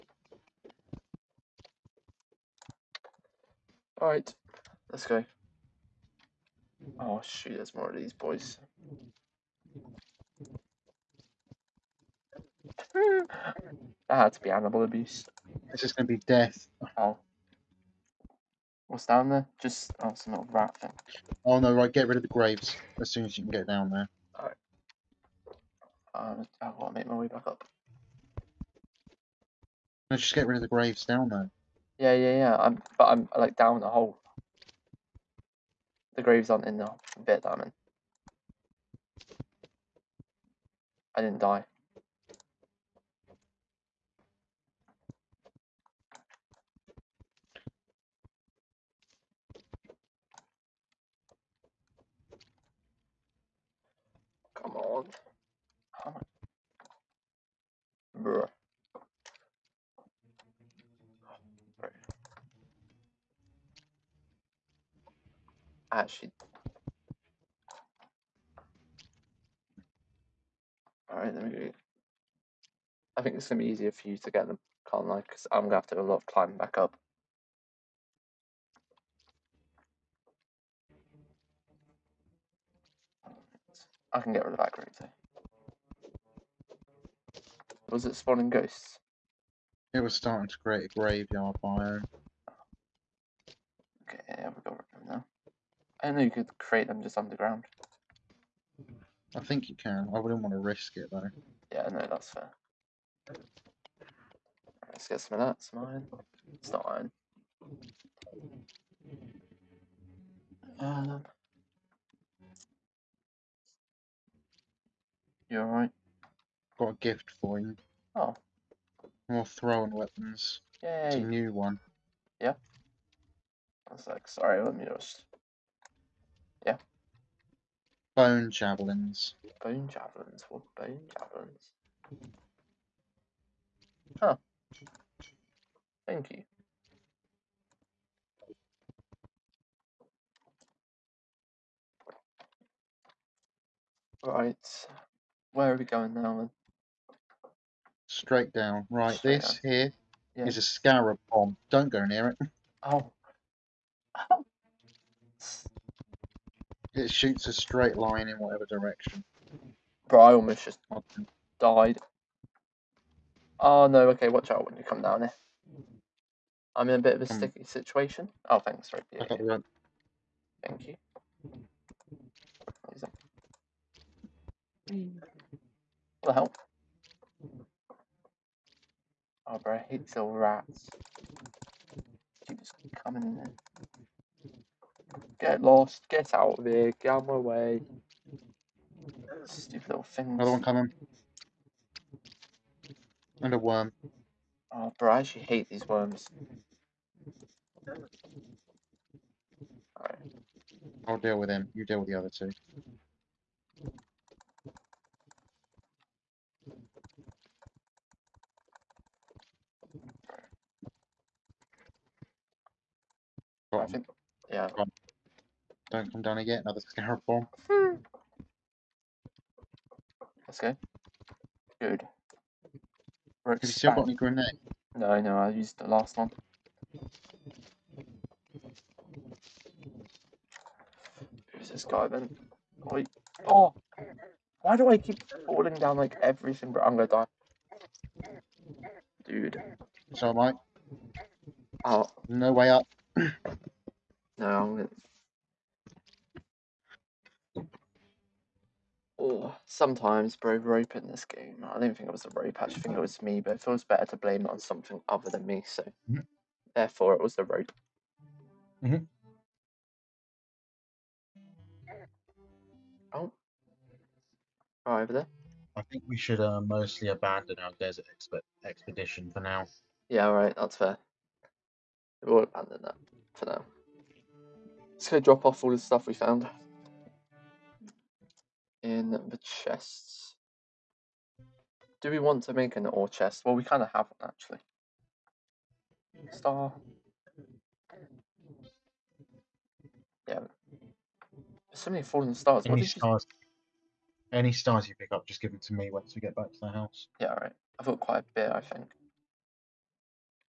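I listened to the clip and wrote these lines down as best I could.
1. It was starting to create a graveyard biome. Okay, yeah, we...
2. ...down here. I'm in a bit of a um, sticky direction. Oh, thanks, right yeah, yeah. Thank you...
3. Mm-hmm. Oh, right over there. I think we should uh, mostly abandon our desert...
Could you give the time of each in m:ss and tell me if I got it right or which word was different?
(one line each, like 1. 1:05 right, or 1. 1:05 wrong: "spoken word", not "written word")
1. 1:29 right
2. 2:45 wrong: "situation", not "direction"
3. 4:18 right.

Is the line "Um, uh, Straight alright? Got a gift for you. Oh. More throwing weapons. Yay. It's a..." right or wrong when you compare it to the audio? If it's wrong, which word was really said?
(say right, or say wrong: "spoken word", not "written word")
wrong: "You", not "Straight".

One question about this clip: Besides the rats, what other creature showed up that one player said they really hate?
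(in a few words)
Worm.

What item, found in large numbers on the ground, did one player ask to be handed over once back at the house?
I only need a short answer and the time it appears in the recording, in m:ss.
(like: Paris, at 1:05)
Fallen stars, at 4:52.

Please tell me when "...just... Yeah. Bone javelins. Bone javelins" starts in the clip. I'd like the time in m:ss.
2:04.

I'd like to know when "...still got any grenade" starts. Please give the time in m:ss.
3:43.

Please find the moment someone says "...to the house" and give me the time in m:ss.
4:56.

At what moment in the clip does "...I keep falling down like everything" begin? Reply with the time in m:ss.
3:54.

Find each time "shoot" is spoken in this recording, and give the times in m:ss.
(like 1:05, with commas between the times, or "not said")
0:07, 2:37.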